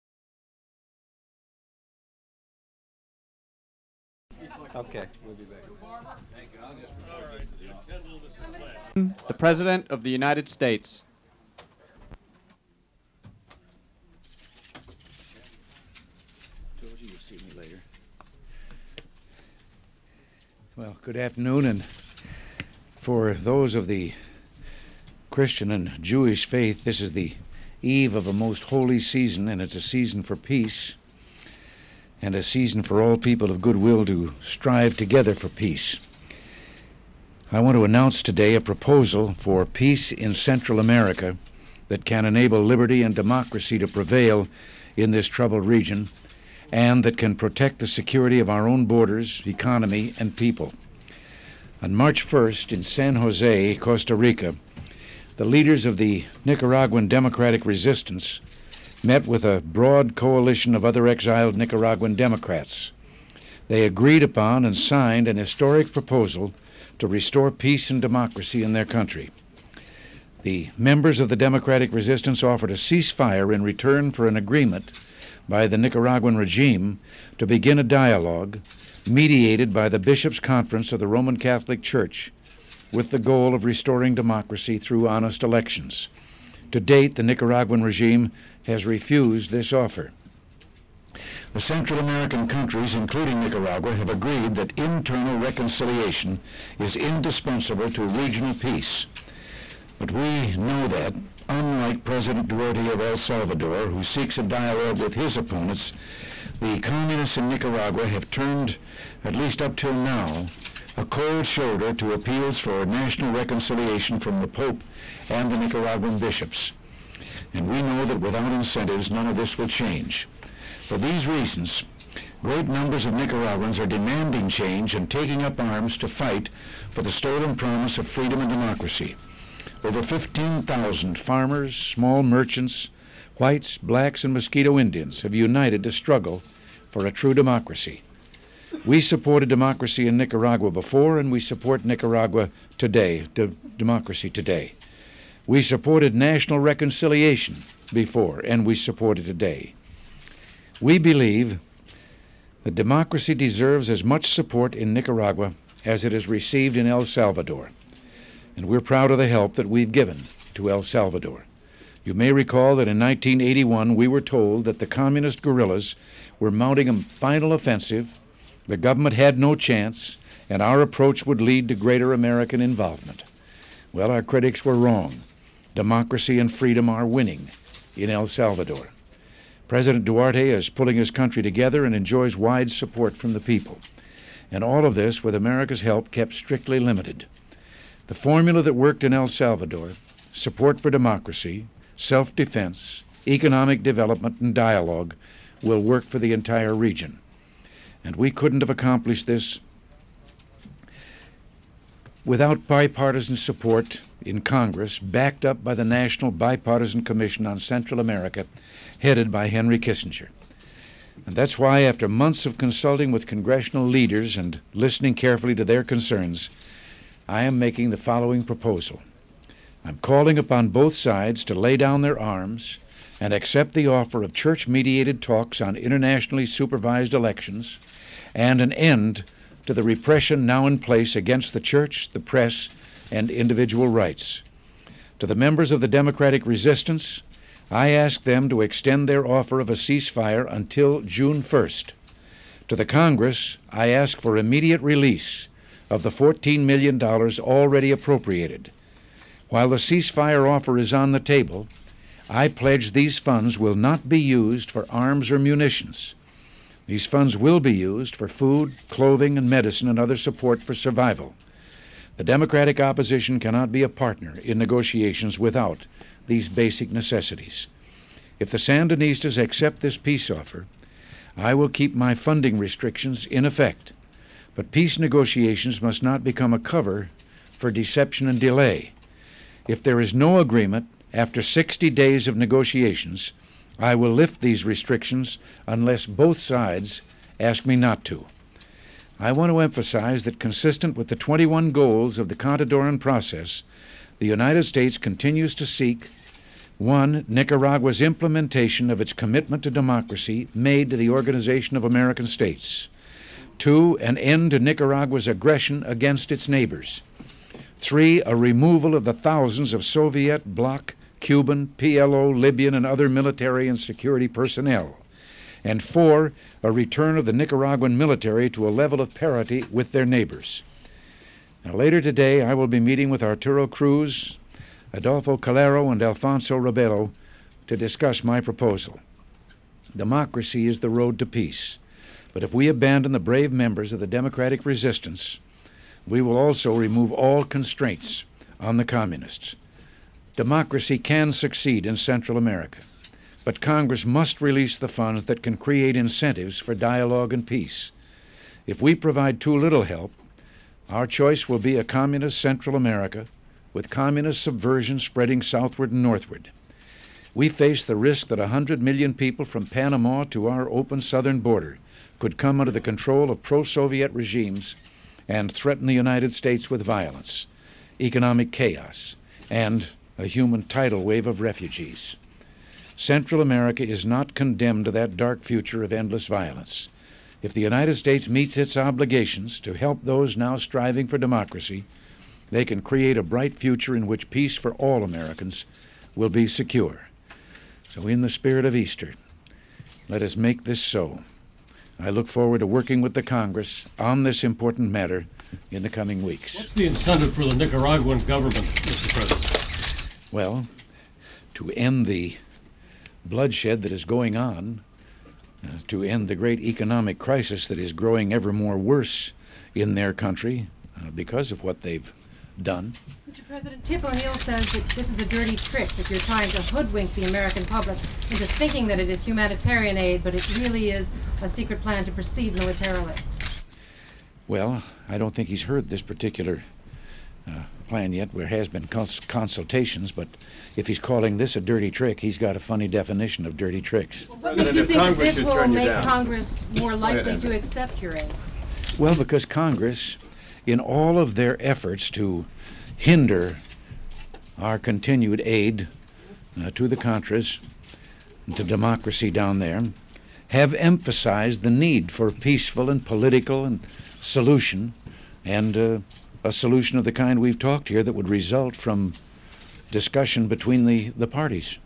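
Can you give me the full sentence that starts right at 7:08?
There has been cons consultations, but if he's calling this a dirty trick, he's got a funny definition of dirty tricks.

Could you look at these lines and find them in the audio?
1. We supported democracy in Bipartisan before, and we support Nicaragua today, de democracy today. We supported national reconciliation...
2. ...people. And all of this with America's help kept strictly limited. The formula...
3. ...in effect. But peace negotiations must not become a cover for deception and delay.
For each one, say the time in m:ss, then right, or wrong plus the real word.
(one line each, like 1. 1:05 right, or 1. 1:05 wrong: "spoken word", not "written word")
1. 2:18 wrong: "Nicaragua", not "Bipartisan"
2. 3:03 right
3. 4:33 right.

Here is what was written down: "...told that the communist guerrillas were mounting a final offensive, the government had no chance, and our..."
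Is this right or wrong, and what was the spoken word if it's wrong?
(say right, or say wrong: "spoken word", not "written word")
right.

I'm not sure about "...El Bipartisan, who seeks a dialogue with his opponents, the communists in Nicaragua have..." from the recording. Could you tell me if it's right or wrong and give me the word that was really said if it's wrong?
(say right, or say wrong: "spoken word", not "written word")
wrong: "Salvador", not "Bipartisan".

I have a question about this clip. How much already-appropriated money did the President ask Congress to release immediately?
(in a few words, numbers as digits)
$14 million.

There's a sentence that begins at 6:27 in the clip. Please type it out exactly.
So, in the spirit of Easter, let us make this so.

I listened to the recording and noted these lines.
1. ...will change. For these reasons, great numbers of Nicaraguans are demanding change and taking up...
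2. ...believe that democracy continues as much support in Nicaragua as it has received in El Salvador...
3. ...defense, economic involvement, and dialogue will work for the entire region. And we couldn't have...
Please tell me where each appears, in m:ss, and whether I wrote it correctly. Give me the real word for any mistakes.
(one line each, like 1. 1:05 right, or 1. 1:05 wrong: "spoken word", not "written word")
1. 1:59 right
2. 2:30 wrong: "deserves", not "continues"
3. 3:12 wrong: "development", not "involvement".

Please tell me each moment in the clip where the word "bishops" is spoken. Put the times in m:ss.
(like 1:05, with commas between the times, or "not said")
1:19, 1:56.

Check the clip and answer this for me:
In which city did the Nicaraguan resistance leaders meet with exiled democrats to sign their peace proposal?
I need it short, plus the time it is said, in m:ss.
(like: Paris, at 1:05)
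San Jose, Costa Rica, at 0:52.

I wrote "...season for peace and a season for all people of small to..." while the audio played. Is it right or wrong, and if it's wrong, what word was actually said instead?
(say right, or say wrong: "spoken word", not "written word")
wrong: "goodwill", not "small".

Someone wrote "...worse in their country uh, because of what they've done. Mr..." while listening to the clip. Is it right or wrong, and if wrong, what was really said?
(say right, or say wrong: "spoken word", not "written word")
right.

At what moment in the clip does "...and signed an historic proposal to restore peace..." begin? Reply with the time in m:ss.
1:04.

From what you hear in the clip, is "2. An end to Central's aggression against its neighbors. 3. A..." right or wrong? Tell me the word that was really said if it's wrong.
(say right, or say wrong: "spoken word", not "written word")
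wrong: "Nicaragua", not "Central".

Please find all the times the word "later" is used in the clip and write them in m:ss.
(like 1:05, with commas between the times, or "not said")
0:17, 5:21.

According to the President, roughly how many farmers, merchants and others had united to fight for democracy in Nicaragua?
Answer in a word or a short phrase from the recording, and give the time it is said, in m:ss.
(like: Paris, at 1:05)
15,000, at 2:10.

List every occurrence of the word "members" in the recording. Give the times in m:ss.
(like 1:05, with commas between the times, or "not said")
1:10, 3:55, 5:33.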